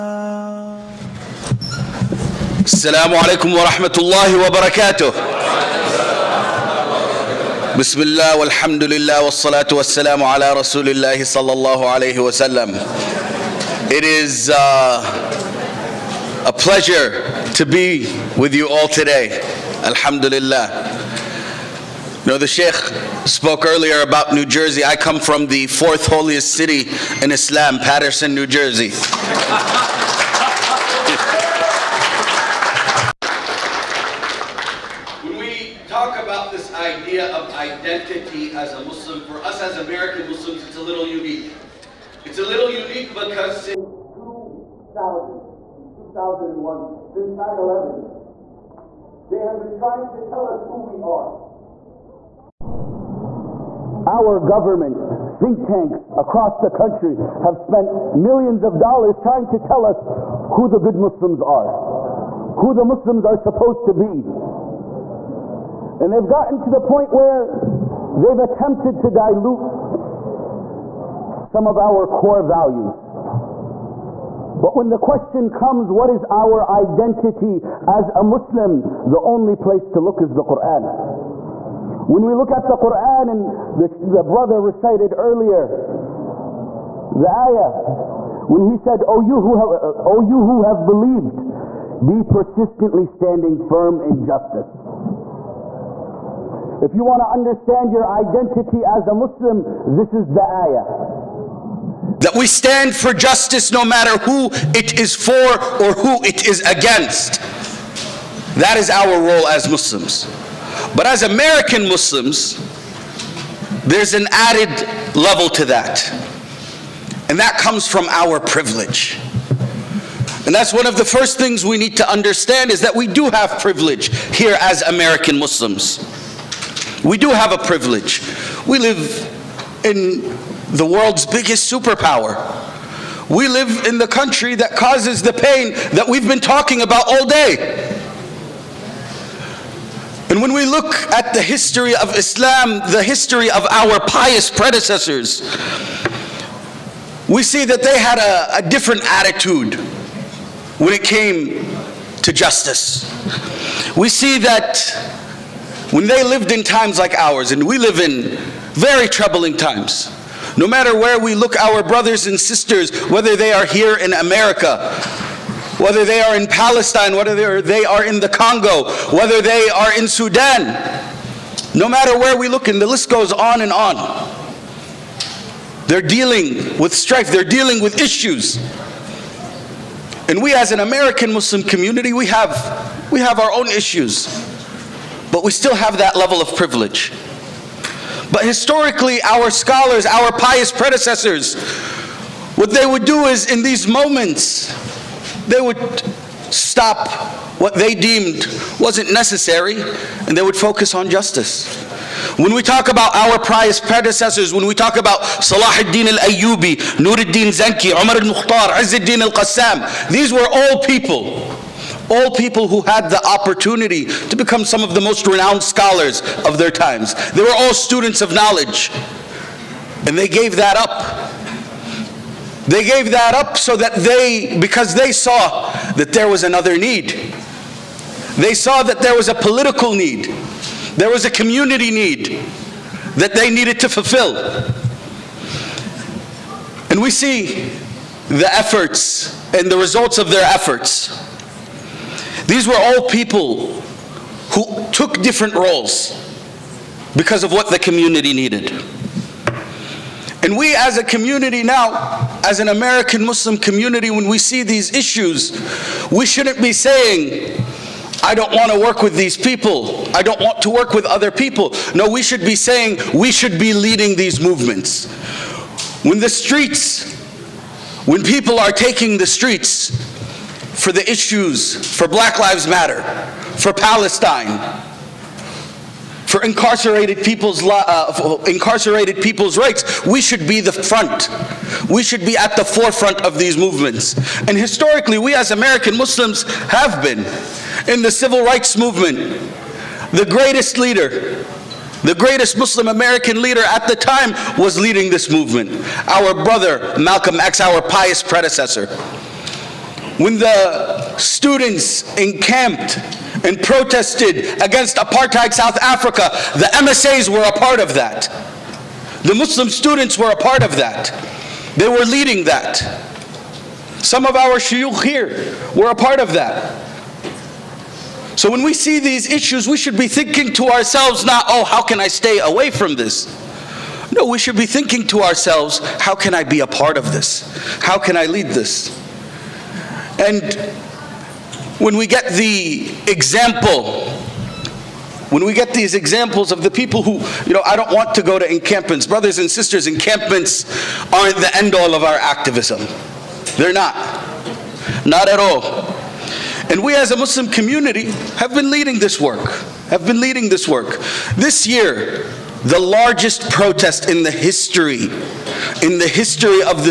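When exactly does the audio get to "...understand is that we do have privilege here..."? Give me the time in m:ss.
2:02.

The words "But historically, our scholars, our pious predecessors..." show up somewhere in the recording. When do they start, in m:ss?
3:08.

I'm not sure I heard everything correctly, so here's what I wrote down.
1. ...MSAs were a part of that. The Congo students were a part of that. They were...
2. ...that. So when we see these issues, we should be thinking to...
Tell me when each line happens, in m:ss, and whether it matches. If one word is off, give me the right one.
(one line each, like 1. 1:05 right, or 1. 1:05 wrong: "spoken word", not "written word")
1. 5:06 wrong: "Muslim", not "Congo"
2. 5:16 right.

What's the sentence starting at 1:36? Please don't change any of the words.
If you want to understand your identity as a Muslim, this is the ayah.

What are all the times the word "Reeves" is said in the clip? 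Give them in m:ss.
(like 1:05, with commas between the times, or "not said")
not said.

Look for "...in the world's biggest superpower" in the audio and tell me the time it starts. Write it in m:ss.
2:09.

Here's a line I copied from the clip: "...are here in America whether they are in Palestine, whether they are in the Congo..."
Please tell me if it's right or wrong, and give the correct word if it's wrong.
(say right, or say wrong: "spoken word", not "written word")
right.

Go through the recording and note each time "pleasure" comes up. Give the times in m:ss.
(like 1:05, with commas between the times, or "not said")
0:16.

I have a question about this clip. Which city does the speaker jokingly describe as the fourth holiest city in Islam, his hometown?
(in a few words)
Paterson, New Jersey.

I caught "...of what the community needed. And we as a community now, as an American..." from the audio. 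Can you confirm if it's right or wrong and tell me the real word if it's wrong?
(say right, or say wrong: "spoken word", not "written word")
right.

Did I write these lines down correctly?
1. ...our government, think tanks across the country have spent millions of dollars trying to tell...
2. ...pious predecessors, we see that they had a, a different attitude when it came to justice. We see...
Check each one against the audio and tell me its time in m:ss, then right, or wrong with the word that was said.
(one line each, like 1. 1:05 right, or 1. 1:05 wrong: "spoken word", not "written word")
1. 0:54 right
2. 2:23 right.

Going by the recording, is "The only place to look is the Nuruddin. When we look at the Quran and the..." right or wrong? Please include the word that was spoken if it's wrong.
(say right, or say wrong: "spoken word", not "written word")
wrong: "Quran", not "Nuruddin".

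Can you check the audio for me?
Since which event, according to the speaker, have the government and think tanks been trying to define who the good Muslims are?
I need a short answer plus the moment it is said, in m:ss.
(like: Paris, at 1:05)
9/11, at 0:47.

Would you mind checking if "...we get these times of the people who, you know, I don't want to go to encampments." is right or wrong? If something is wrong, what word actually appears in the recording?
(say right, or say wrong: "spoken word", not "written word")
wrong: "examples", not "times".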